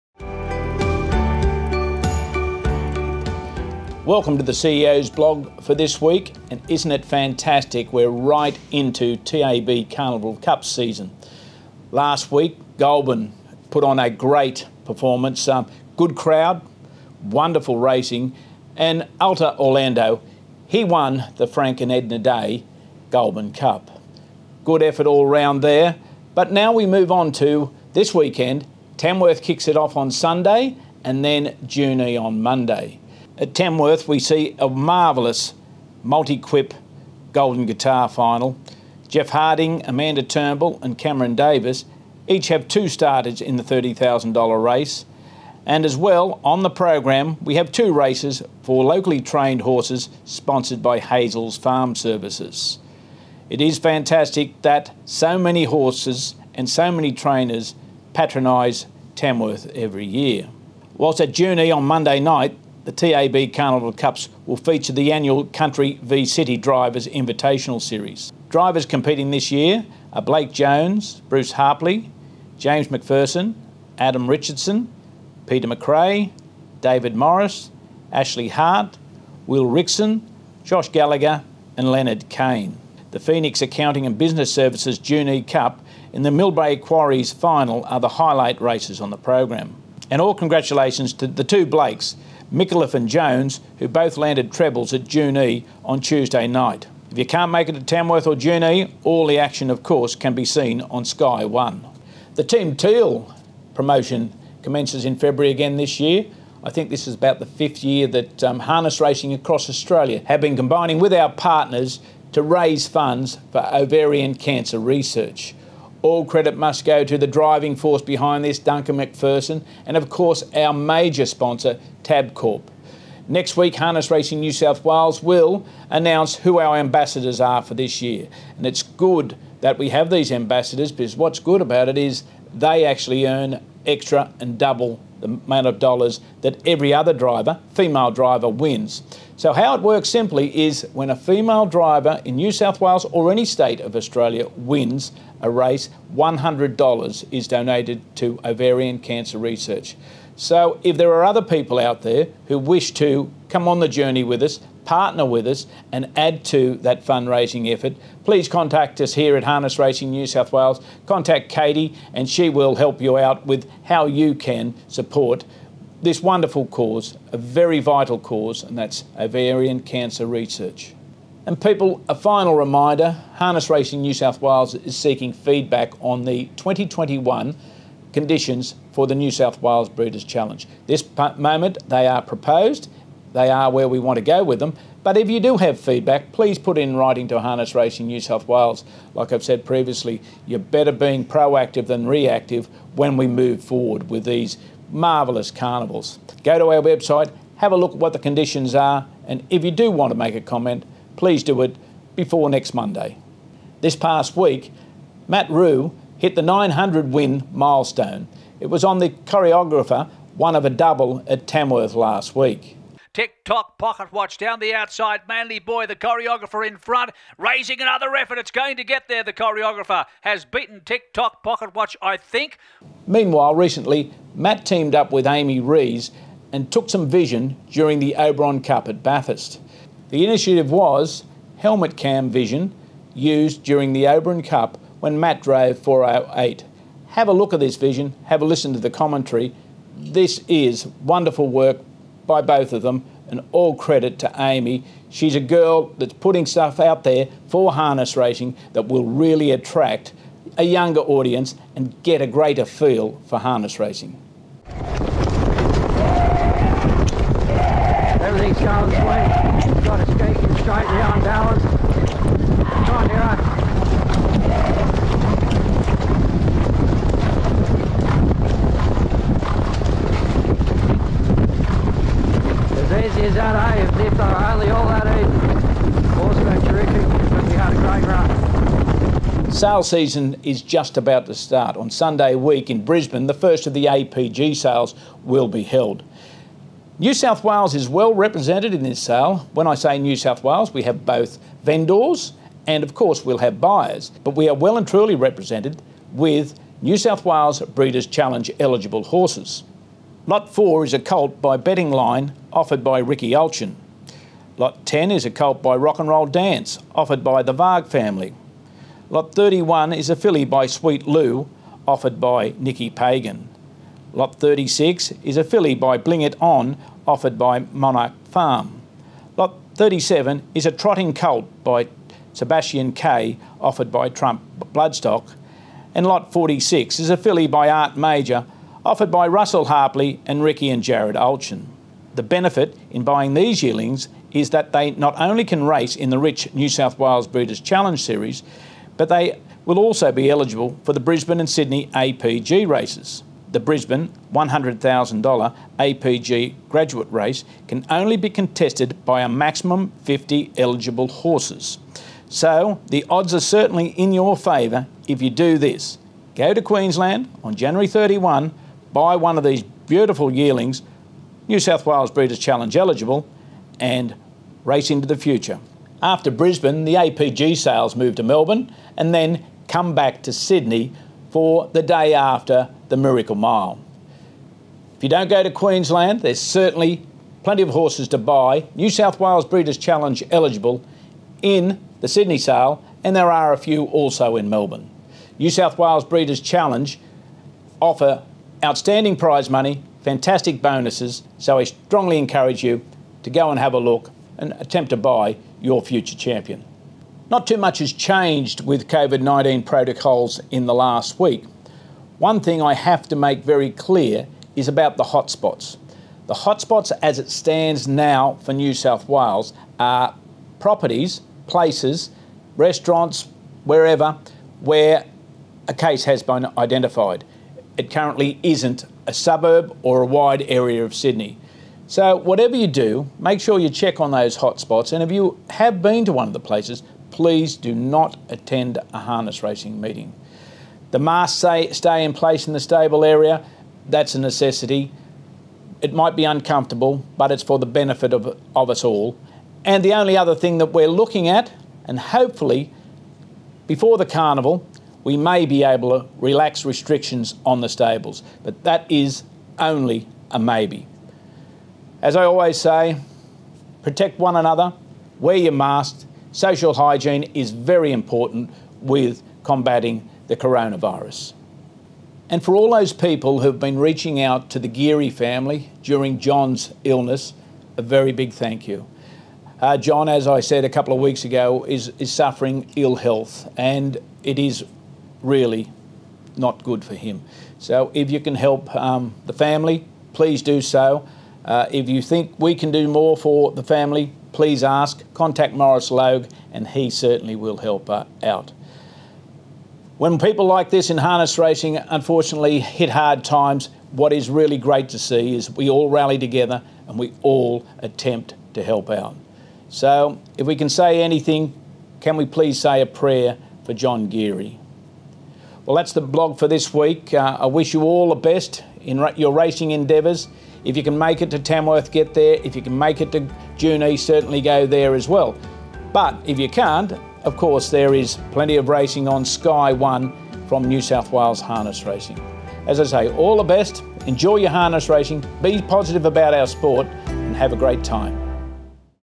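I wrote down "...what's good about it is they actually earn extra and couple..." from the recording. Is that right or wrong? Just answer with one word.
wrong.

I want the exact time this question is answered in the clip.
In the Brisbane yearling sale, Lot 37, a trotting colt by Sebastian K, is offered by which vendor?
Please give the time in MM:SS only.
05:24.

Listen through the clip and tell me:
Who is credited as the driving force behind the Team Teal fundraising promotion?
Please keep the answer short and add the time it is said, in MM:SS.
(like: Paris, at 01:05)
Duncan McPherson, at 01:58.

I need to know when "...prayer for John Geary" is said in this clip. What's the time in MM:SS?
08:22.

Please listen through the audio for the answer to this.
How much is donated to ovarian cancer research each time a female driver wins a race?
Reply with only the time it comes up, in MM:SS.
02:26.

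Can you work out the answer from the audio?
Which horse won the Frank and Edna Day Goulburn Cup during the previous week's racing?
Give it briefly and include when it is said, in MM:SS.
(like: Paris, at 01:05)
Alta Orlando, at 00:19.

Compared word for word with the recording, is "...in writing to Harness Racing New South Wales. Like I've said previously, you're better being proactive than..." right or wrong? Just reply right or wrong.
right.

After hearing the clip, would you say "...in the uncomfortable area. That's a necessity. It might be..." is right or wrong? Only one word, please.
wrong.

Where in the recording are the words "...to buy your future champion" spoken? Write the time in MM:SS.
06:34.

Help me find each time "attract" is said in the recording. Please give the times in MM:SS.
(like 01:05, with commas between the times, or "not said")
04:09.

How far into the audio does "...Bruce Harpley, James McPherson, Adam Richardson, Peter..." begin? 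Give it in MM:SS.
01:11.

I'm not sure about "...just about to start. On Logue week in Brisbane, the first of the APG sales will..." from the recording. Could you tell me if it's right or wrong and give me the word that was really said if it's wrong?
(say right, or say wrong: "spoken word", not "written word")
wrong: "Sunday", not "Logue".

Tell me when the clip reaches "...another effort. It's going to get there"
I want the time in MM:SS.
03:37.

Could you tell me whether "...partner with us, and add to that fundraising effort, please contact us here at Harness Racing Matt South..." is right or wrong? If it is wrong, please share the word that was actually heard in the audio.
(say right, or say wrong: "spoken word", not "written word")
wrong: "New", not "Matt".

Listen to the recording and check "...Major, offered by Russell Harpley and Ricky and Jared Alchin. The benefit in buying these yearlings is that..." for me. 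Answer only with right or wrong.
right.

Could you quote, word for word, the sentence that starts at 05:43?
The Brisbane $100,000 APG graduate race can only be contested by a maximum 50 eligible horses.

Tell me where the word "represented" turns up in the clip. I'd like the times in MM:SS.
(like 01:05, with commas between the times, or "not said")
04:48, 04:55.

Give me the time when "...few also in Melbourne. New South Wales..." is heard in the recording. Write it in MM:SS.
06:23.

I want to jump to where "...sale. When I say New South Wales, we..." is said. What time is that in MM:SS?
04:48.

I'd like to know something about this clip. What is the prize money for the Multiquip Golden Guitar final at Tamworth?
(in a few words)
$30,000.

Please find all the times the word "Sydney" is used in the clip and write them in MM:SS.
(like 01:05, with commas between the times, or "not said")
05:41, 06:10, 06:22, 07:00.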